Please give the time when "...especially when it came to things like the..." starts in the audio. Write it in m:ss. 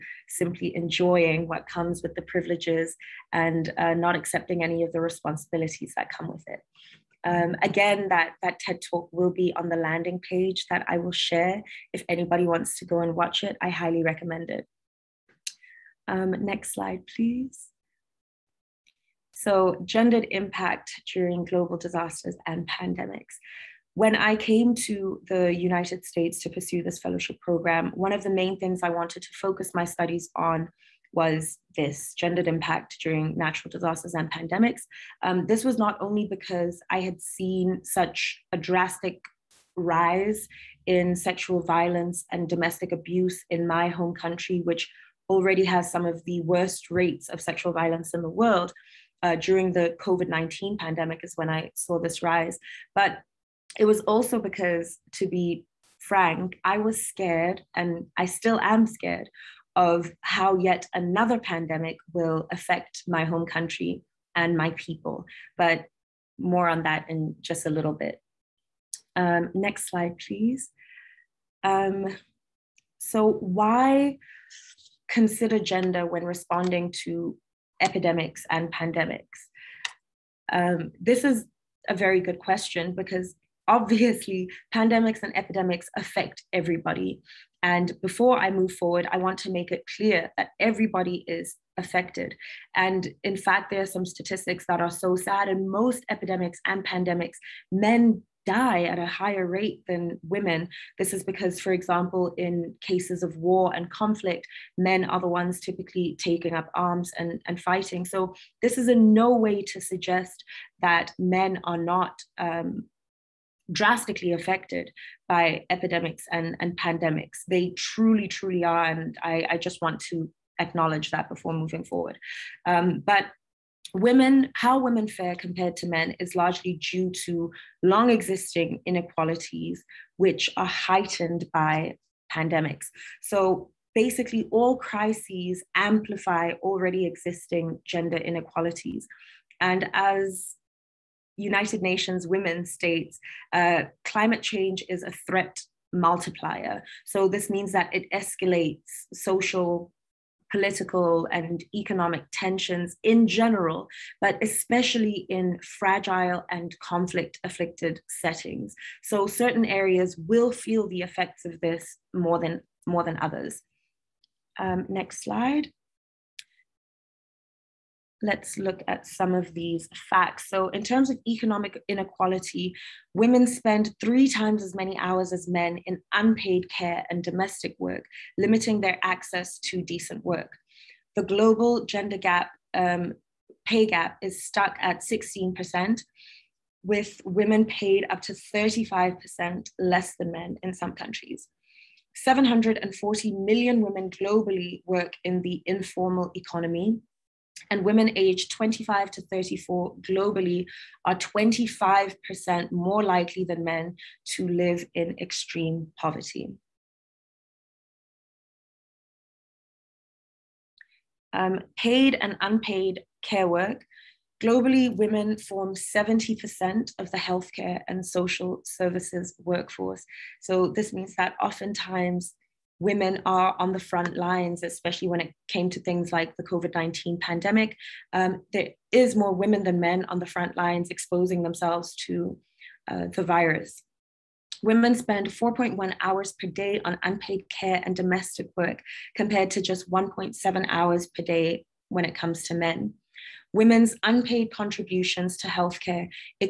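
3:44.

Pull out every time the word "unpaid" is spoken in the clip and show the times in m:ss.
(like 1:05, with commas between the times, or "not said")
2:56, 3:32, 3:57, 4:04.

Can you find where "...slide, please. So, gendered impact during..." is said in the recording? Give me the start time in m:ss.
0:16.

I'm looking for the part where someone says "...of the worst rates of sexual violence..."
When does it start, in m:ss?
0:46.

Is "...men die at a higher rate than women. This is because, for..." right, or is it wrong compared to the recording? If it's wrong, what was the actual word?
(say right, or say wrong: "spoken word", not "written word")
right.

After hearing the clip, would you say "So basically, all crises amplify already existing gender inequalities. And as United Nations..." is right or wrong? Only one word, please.
right.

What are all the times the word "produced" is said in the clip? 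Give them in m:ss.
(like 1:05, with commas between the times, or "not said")
not said.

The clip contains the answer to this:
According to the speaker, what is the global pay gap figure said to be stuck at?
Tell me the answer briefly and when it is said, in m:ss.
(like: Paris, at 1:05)
16%, at 3:05.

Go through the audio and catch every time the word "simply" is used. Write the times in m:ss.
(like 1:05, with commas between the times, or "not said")
0:00.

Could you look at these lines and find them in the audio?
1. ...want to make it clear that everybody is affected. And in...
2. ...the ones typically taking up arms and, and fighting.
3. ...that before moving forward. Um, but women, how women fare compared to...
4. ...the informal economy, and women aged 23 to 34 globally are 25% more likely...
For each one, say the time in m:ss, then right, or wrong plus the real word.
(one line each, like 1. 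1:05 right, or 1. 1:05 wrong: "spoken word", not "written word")
1. 1:29 right
2. 1:45 right
3. 2:01 right
4. 3:15 wrong: "25", not "23".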